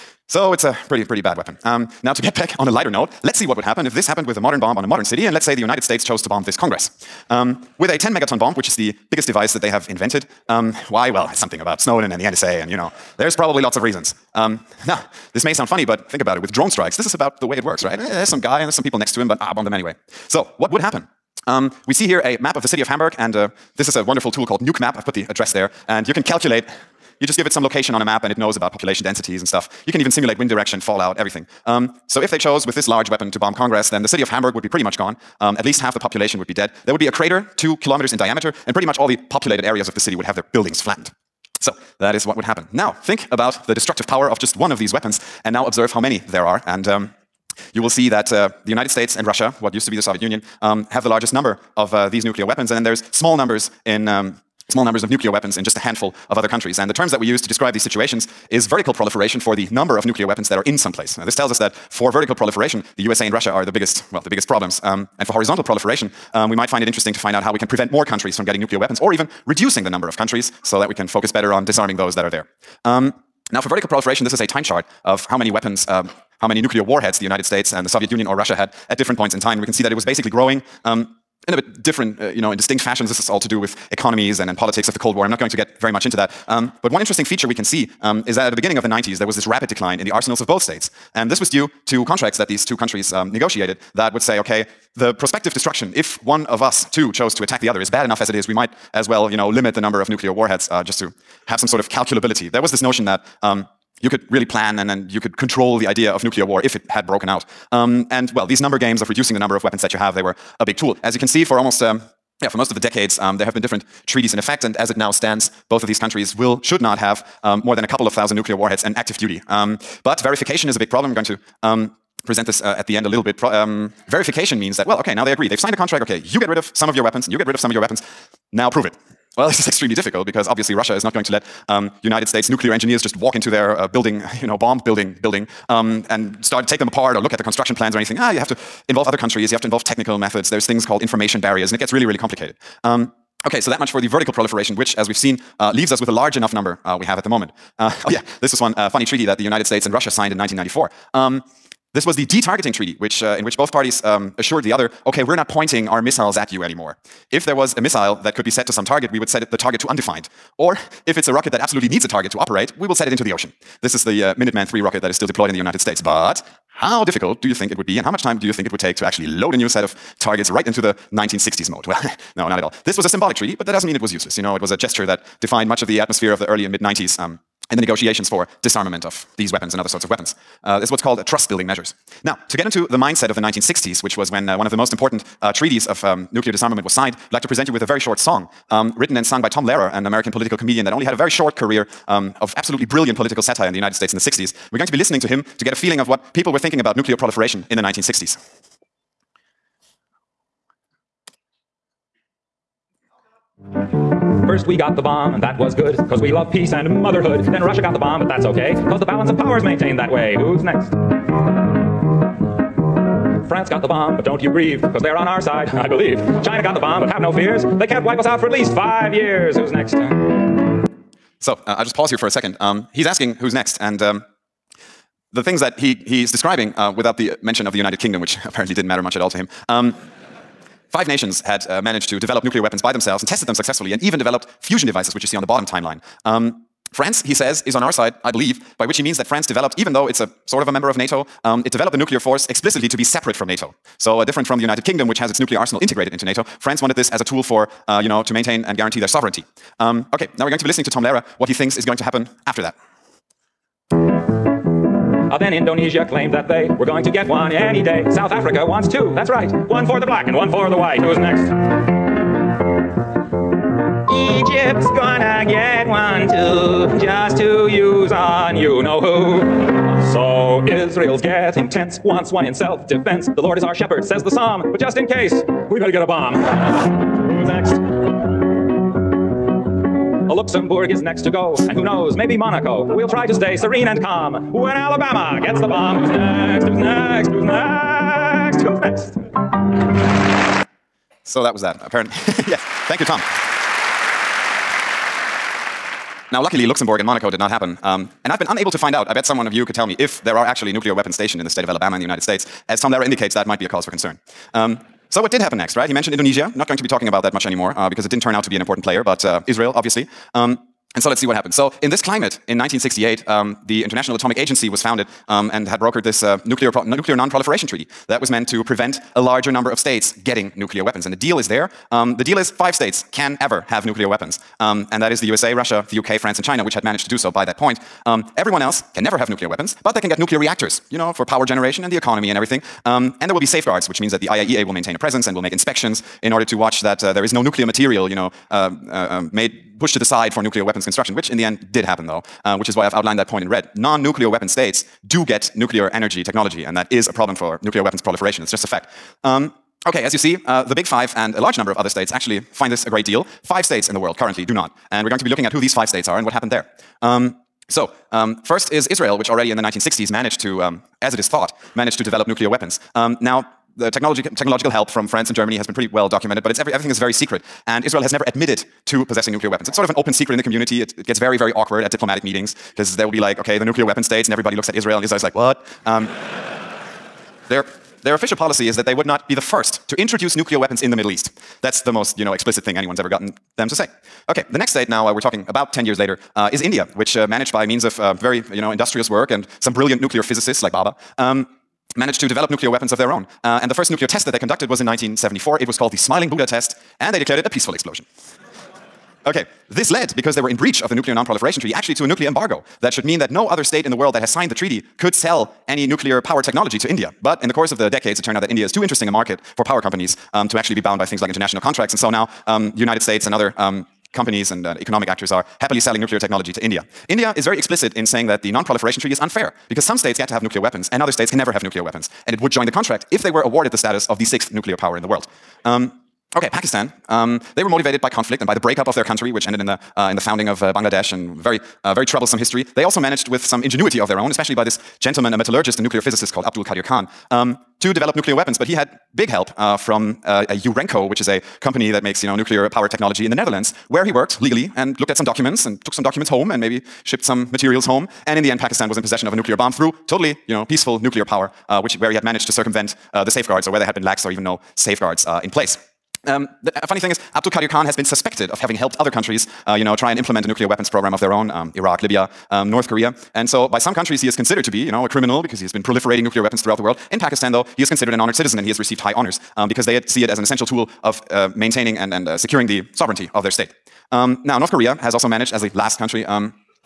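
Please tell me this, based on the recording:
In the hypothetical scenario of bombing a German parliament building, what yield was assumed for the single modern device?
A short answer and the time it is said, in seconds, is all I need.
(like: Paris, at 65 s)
10 megatons, at 7 s.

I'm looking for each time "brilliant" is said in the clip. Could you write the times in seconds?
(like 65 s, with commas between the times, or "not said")
192 s, 389 s.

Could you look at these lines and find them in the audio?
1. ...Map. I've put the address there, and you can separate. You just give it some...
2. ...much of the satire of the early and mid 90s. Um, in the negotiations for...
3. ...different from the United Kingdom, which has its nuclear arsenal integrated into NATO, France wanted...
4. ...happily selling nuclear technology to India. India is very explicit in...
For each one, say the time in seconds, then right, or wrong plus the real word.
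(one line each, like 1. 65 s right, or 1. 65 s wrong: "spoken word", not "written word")
1. 24 s wrong: "calculate", not "separate"
2. 175 s wrong: "atmosphere", not "satire"
3. 244 s right
4. 415 s right.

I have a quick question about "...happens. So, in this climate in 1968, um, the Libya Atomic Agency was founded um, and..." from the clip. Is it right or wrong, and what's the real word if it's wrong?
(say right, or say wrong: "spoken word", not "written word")
wrong: "International", not "Libya".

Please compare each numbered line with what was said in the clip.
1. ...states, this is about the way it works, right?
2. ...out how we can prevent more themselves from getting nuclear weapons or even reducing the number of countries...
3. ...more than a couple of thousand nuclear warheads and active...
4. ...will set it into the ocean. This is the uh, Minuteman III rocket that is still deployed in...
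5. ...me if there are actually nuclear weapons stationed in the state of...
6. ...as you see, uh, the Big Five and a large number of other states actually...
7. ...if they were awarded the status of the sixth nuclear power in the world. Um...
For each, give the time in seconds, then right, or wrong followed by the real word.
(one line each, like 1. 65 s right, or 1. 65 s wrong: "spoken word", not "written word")
1. 16 s wrong: "strikes", not "states"
2. 67 s wrong: "countries", not "themselves"
3. 117 s right
4. 162 s right
5. 299 s right
6. 350 s right
7. 423 s right.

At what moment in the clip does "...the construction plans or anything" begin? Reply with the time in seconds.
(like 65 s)
137 s.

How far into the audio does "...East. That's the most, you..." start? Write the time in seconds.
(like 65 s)
381 s.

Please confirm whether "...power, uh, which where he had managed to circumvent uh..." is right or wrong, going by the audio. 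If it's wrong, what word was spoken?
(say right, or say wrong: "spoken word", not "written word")
right.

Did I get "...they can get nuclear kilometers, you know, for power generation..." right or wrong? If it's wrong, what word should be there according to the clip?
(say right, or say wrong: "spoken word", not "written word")
wrong: "reactors", not "kilometers".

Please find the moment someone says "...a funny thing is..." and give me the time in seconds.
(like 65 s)
456 s.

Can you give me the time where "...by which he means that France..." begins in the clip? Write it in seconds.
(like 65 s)
238 s.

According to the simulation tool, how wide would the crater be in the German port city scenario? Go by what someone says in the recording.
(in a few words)
2 kilometers.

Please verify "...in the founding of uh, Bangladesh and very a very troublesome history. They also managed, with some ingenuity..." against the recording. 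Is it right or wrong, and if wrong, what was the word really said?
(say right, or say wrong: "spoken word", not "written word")
right.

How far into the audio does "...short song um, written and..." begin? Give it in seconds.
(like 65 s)
187 s.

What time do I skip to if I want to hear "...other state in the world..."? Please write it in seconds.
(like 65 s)
403 s.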